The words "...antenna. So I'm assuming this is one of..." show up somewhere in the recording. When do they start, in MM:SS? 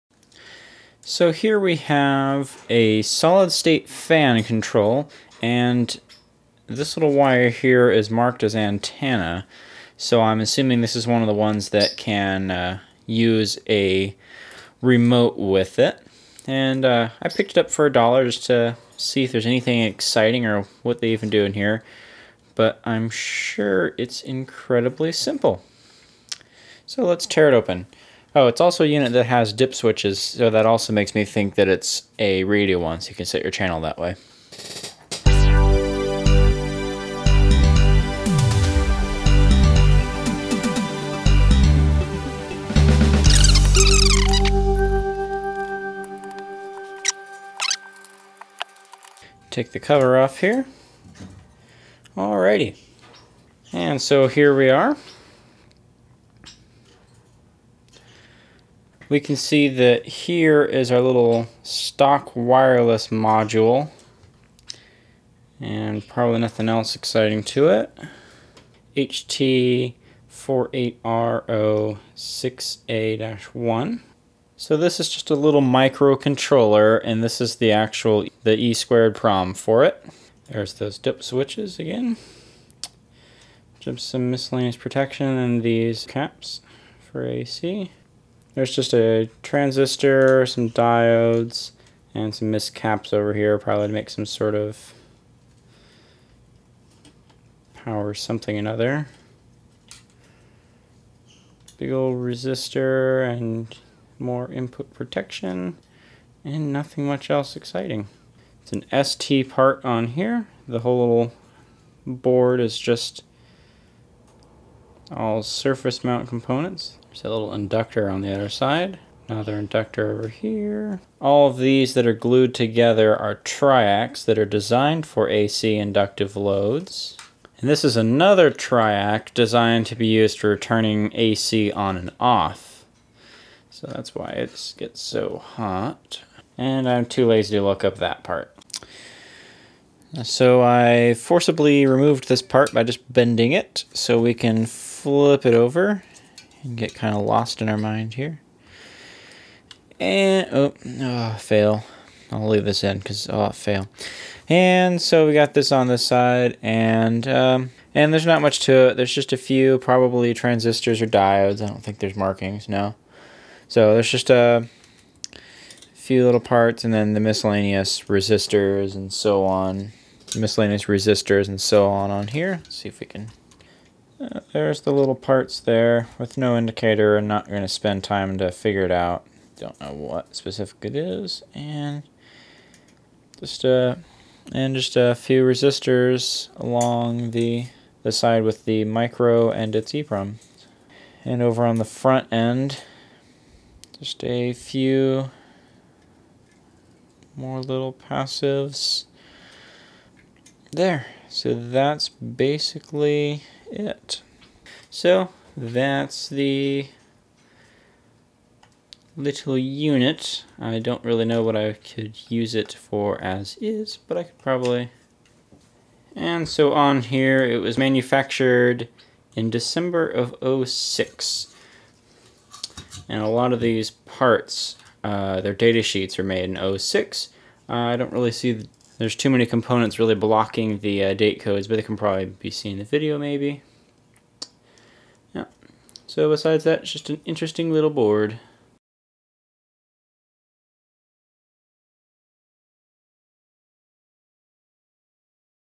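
00:08.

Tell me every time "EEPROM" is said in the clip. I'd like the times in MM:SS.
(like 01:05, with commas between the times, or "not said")
03:09.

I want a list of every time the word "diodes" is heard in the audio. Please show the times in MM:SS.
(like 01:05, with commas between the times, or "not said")
01:30, 02:41.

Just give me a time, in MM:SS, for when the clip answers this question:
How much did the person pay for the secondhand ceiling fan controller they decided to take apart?
00:17.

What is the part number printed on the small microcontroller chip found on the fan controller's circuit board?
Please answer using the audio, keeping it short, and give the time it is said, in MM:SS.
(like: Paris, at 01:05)
HT48R06A-1, at 01:08.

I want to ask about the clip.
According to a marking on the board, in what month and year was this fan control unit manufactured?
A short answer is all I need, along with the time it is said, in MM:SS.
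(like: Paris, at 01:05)
December 2006, at 03:39.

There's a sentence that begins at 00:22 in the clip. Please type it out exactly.
But I'm sure it's incredibly simple.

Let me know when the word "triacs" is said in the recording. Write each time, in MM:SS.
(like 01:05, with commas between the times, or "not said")
02:03, 02:08.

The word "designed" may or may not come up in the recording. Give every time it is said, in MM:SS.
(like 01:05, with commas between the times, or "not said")
02:04, 02:09.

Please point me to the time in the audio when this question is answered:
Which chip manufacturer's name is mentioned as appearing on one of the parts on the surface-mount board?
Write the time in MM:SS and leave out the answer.
01:49.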